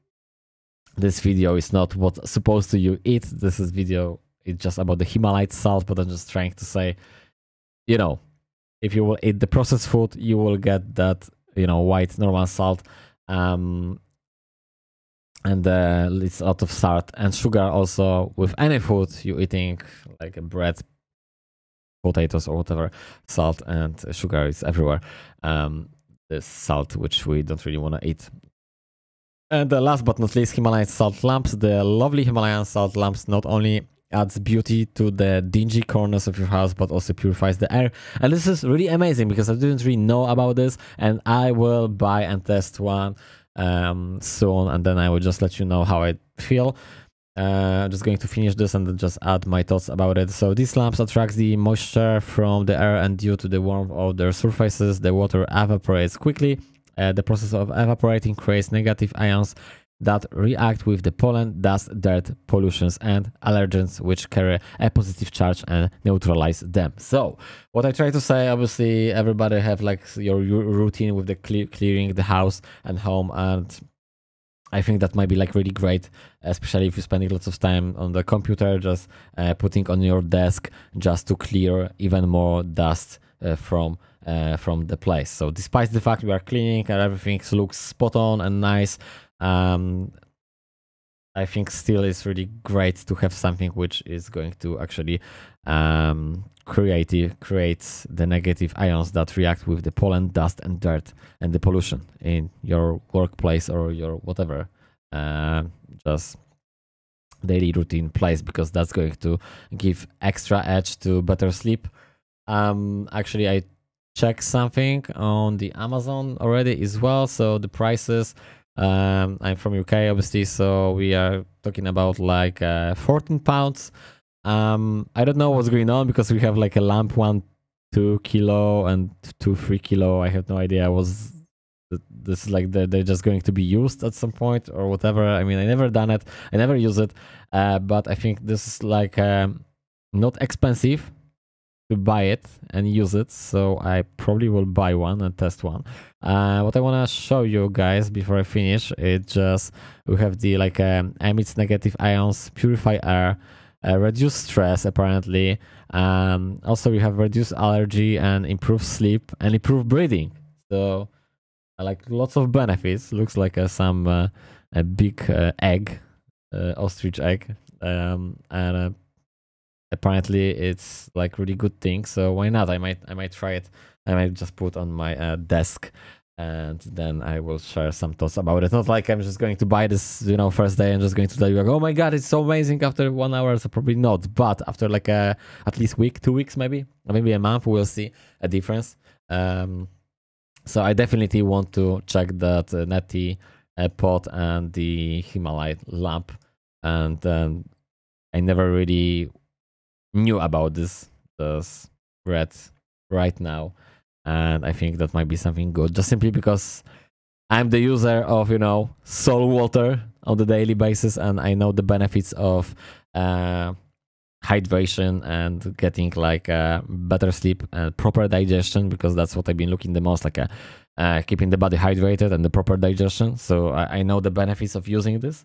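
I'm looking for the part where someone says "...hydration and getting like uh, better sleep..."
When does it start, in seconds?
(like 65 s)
214 s.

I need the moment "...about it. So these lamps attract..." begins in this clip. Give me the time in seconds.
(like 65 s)
49 s.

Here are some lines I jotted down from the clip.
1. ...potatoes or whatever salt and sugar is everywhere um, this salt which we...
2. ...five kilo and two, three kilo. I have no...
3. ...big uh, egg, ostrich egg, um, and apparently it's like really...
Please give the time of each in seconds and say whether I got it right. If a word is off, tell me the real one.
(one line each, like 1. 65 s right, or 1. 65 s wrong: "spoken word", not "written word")
1. 22 s right
2. 127 s wrong: "two", not "five"
3. 164 s right.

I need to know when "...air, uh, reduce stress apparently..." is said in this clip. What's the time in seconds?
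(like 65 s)
153 s.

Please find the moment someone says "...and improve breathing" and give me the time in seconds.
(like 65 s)
159 s.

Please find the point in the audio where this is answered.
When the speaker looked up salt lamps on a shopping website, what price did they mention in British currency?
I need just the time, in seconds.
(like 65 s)
122 s.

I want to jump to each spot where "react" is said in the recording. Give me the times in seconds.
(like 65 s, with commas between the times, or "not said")
60 s, 99 s.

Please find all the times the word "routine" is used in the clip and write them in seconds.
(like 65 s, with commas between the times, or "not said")
70 s, 107 s.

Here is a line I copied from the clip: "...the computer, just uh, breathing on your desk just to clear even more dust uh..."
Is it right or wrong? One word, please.
wrong.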